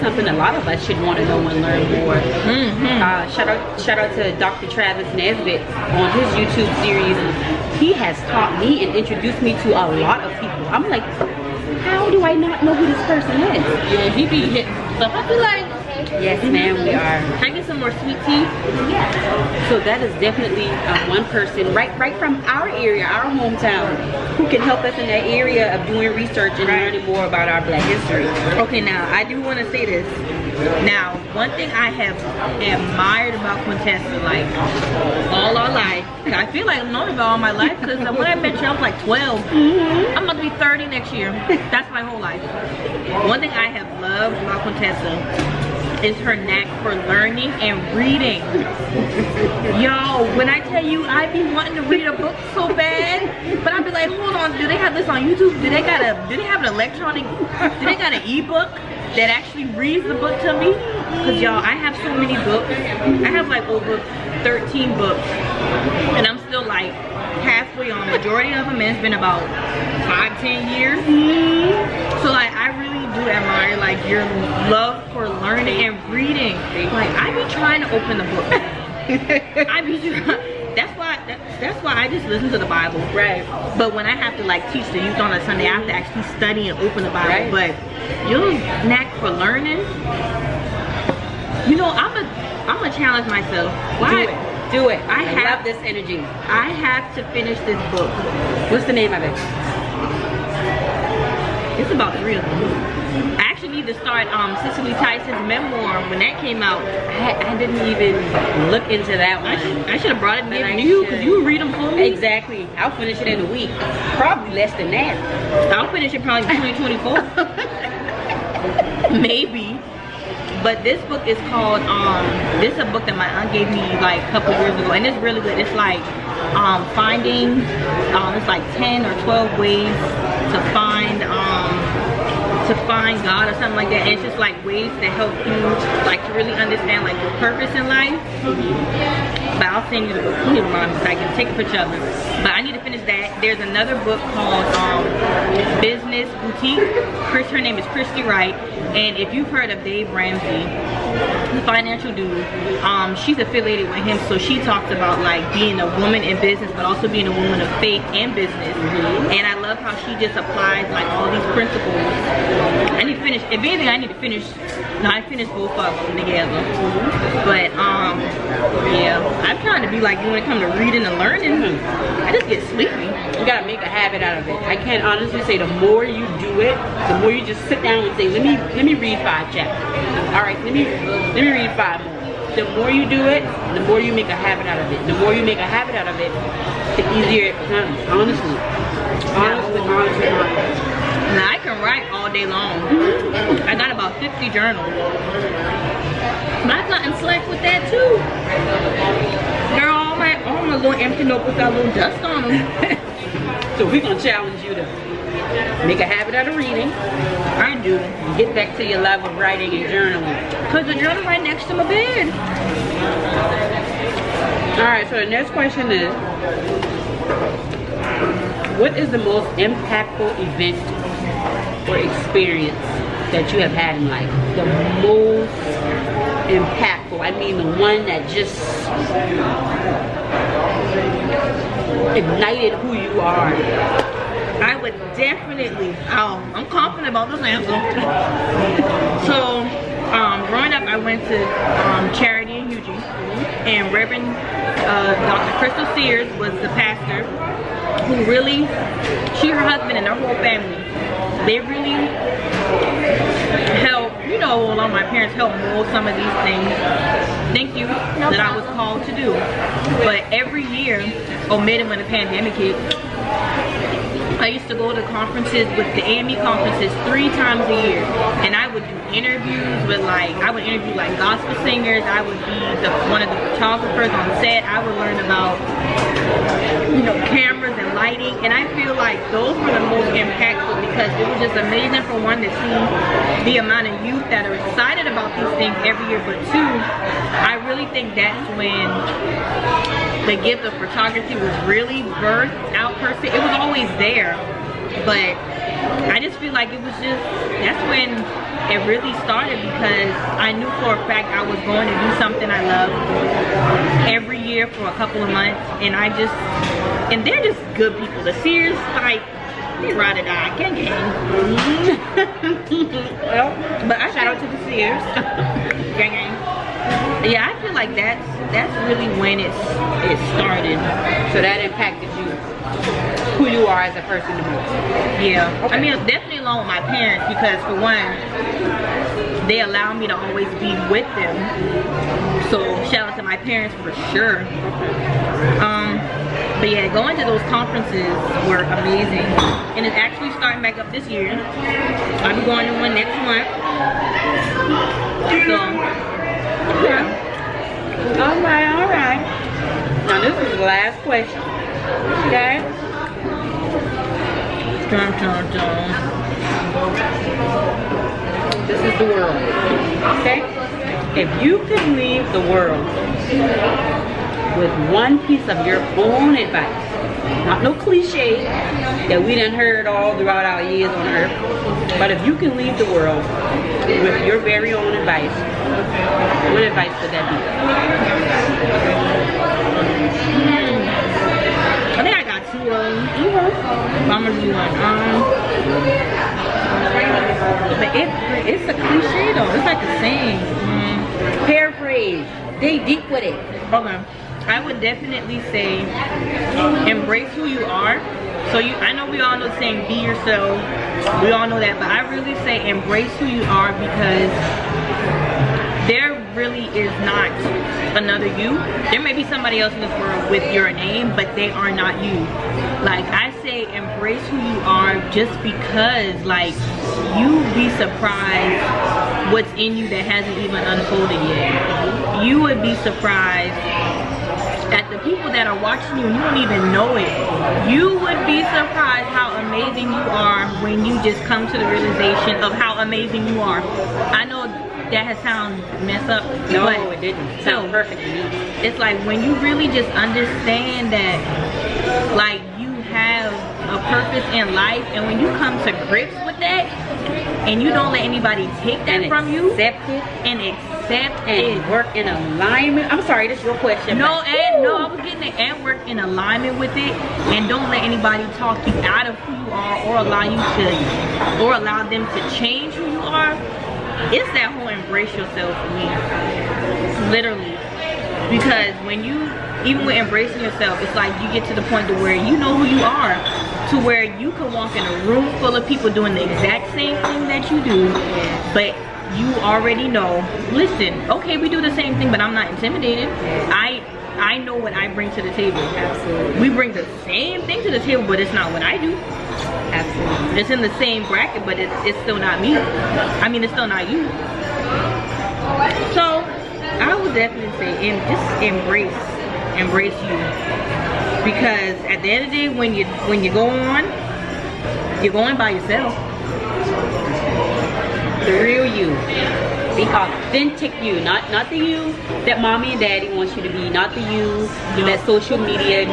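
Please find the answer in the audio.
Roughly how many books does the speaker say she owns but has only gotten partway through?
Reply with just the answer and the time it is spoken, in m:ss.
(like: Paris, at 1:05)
over 13, at 1:03.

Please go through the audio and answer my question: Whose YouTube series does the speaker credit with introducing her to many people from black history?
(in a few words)
Dr. Travis Nesbitt.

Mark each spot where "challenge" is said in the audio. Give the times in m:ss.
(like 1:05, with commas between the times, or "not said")
1:32, 3:24.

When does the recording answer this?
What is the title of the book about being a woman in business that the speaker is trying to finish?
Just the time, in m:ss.
2:25.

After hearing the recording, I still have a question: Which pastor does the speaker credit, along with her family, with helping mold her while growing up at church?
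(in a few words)
Dr. Crystal Sears.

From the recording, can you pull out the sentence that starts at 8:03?
I I know what I bring to the table.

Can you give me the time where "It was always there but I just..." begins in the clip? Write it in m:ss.
4:53.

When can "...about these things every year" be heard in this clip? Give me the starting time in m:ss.
4:45.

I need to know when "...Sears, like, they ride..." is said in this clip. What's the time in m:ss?
5:08.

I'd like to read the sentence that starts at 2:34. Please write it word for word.
So she talks about like being a woman in business, but also being a woman of faith and business.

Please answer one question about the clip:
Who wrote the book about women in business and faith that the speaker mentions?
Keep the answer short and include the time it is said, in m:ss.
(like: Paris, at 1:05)
Christy Wright, at 2:27.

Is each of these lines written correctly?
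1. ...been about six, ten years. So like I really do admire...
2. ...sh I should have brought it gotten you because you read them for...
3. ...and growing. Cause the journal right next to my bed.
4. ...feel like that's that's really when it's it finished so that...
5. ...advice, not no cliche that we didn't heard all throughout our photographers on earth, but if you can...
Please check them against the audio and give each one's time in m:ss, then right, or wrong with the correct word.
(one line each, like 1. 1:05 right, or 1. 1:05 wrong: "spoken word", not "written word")
1. 1:09 wrong: "five", not "six"
2. 1:49 wrong: "given", not "gotten"
3. 3:29 wrong: "journaling", not "growing"
4. 5:17 wrong: "started", not "finished"
5. 6:06 wrong: "years", not "photographers".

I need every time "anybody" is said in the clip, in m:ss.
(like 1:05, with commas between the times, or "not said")
7:28, 7:37.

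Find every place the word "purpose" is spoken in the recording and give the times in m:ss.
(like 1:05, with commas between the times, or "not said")
2:17, 7:23.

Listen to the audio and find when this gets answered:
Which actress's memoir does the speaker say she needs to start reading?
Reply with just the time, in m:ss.
1:44.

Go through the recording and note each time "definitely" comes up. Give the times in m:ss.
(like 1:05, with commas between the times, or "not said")
0:20, 3:55, 5:26, 6:34, 8:17.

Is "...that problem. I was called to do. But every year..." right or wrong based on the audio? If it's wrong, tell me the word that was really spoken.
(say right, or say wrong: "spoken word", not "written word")
right.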